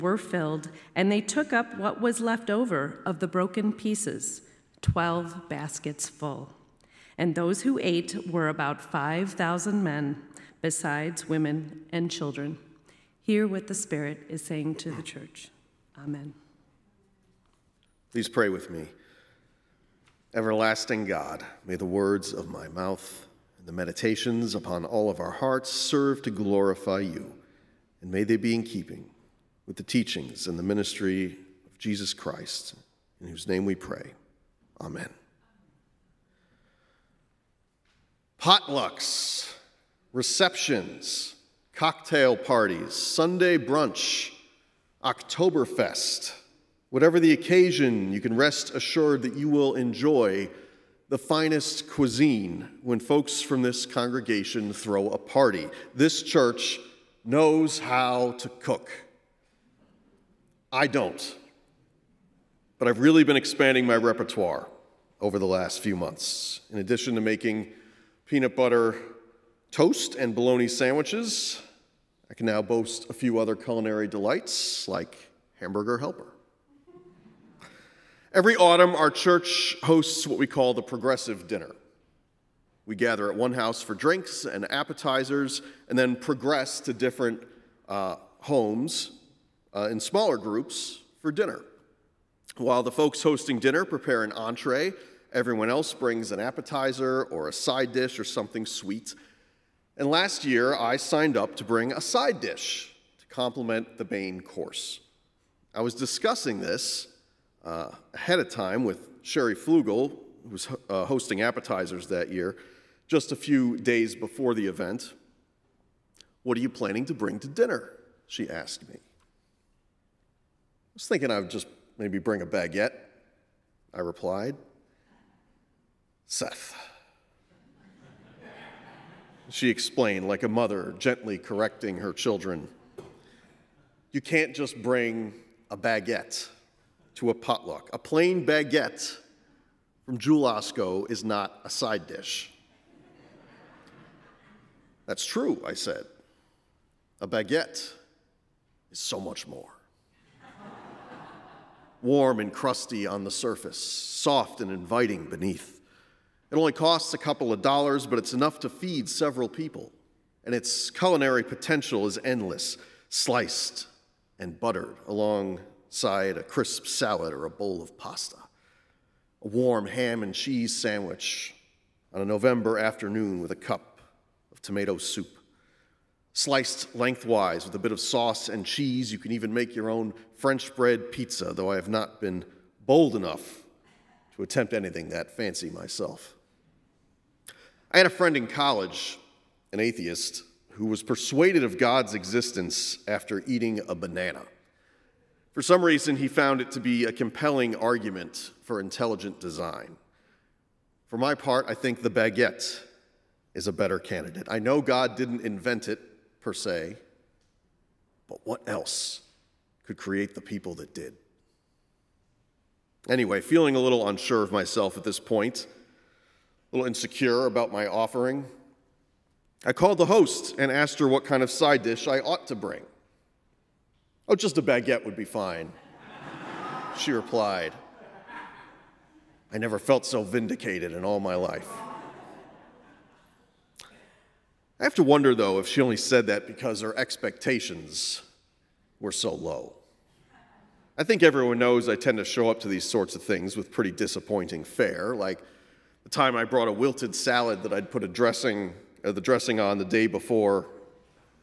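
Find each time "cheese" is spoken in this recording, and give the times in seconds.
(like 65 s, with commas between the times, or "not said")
170 s, 178 s.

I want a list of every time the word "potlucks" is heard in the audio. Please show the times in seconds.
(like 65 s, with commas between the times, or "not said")
38 s, 137 s.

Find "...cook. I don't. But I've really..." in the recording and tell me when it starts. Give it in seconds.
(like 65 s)
58 s.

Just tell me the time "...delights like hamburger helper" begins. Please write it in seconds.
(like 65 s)
74 s.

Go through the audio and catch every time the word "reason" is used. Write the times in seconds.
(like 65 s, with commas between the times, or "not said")
195 s.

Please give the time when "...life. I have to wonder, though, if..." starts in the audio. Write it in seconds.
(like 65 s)
231 s.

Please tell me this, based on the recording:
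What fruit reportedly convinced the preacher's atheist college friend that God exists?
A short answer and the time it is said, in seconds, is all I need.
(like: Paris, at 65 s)
A banana, at 193 s.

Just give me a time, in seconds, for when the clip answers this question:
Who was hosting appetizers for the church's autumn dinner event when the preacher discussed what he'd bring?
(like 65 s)
109 s.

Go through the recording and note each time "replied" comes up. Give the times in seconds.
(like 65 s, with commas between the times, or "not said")
123 s, 227 s.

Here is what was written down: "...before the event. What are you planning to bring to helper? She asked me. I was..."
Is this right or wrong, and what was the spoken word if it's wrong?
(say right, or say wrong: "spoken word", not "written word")
wrong: "dinner", not "helper".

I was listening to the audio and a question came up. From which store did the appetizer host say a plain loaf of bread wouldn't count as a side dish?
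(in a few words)
Osco.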